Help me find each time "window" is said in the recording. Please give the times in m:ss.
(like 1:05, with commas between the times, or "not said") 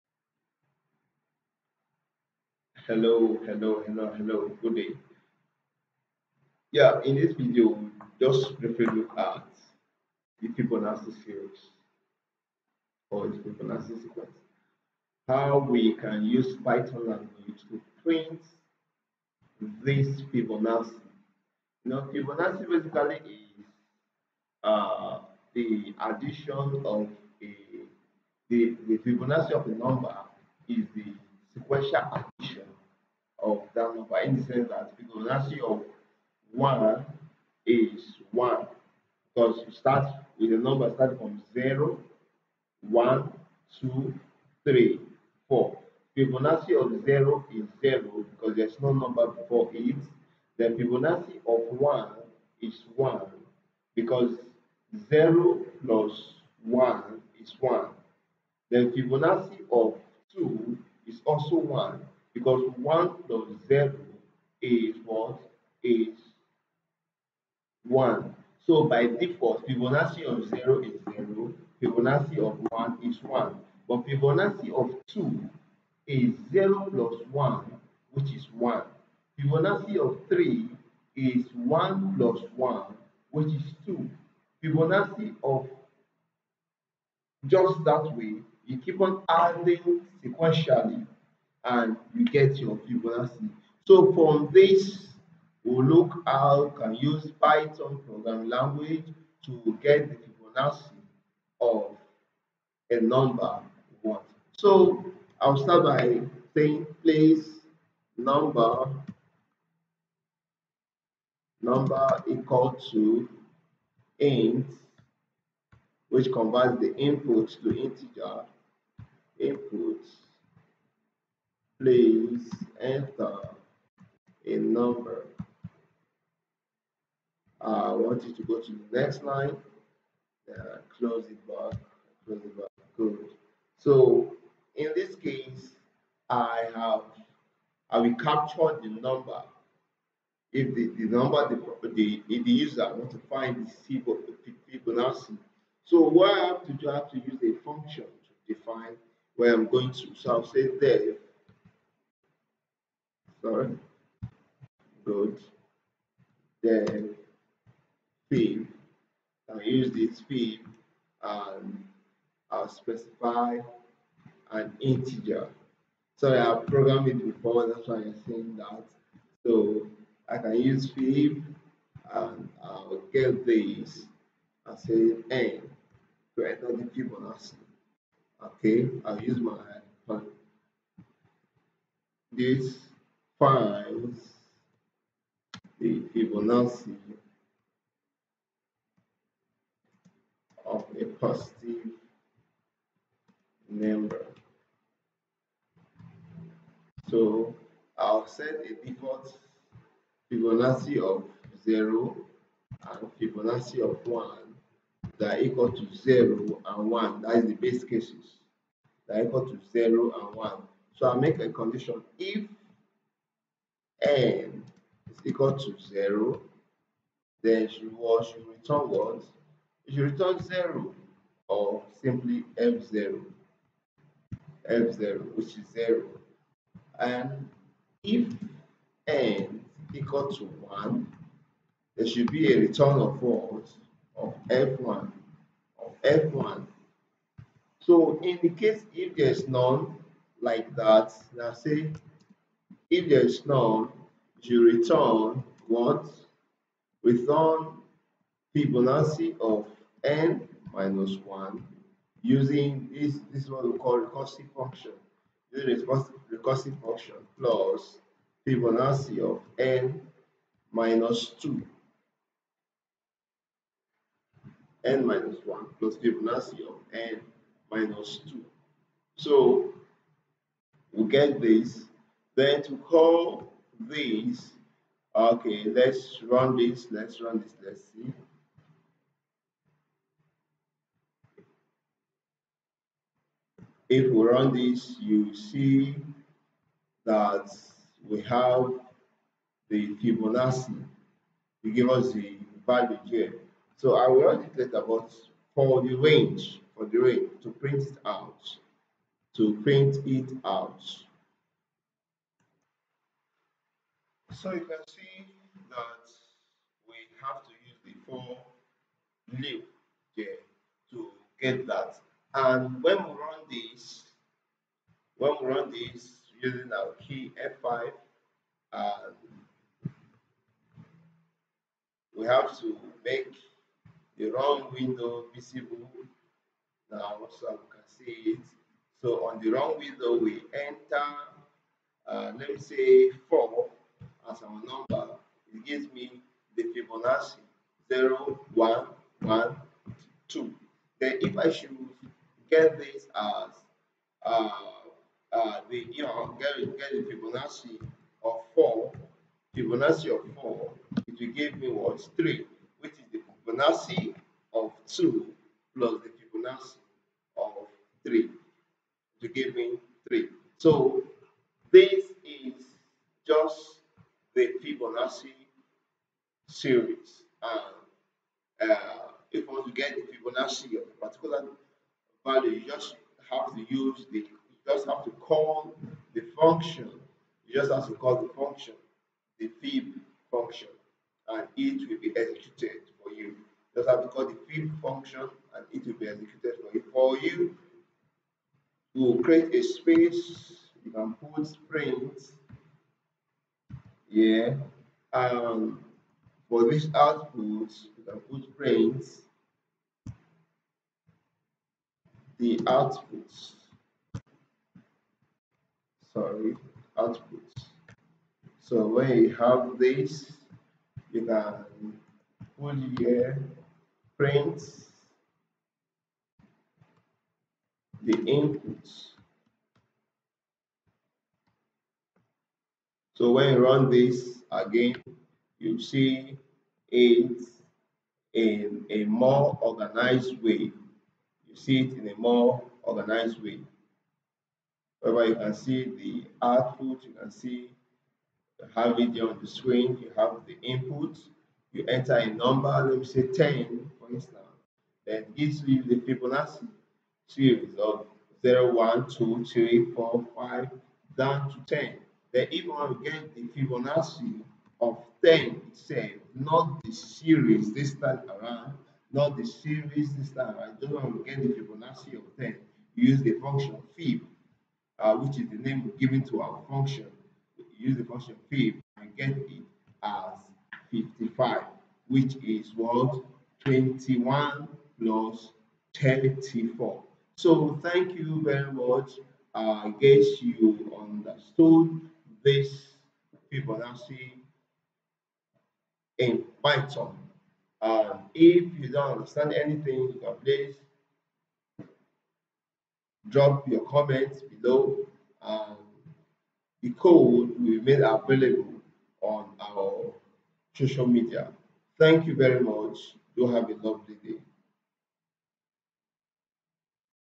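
5:24, 5:29.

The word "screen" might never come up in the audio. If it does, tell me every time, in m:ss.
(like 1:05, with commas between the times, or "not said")
7:19.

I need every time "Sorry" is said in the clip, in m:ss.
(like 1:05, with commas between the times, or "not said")
2:46, 6:46.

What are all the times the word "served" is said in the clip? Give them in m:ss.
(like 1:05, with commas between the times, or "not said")
not said.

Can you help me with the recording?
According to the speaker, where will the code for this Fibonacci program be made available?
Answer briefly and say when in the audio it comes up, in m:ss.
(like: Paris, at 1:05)
social media, at 8:20.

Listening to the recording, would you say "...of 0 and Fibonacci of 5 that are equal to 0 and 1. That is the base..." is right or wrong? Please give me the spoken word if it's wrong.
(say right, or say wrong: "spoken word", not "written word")
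wrong: "1", not "5".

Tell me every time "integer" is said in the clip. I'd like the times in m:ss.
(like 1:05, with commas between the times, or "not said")
1:57, 2:44.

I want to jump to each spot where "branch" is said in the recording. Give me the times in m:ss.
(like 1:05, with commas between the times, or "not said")
not said.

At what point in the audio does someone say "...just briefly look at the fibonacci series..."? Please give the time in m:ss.
0:08.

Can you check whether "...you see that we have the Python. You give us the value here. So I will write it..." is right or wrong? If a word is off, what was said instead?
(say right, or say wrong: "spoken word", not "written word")
wrong: "Fibonacci", not "Python".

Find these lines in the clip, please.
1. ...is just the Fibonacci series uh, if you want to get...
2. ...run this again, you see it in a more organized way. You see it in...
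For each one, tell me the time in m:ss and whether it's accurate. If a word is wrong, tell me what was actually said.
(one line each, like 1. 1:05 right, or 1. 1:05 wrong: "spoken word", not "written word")
1. 6:02 right
2. 7:03 right.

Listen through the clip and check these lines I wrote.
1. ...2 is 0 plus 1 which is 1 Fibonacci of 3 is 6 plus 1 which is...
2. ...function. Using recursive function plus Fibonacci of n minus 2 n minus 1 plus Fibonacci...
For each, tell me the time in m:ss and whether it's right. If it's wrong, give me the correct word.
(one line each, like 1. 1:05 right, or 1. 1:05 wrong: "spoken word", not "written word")
1. 1:15 wrong: "1", not "6"
2. 4:14 right.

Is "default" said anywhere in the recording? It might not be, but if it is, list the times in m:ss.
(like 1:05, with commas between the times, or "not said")
1:09, 3:18.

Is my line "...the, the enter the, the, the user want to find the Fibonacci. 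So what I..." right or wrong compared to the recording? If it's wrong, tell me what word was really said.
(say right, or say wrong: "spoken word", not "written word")
wrong: "number", not "enter".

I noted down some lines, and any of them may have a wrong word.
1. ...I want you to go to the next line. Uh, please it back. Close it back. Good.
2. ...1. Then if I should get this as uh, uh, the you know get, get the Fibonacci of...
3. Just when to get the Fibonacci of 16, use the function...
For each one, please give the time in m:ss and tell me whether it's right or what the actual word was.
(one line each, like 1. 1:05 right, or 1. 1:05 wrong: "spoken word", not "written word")
1. 2:07 wrong: "close", not "please"
2. 5:40 wrong: "2", not "1"
3. 7:40 wrong: "10", not "16".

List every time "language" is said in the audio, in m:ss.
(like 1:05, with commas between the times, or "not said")
0:17, 1:38.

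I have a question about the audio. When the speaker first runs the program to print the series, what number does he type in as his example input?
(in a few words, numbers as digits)
4.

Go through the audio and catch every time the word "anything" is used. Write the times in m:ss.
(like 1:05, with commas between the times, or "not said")
8:09.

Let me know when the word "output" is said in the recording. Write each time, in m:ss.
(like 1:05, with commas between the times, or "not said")
6:36, 6:42, 6:46, 7:16.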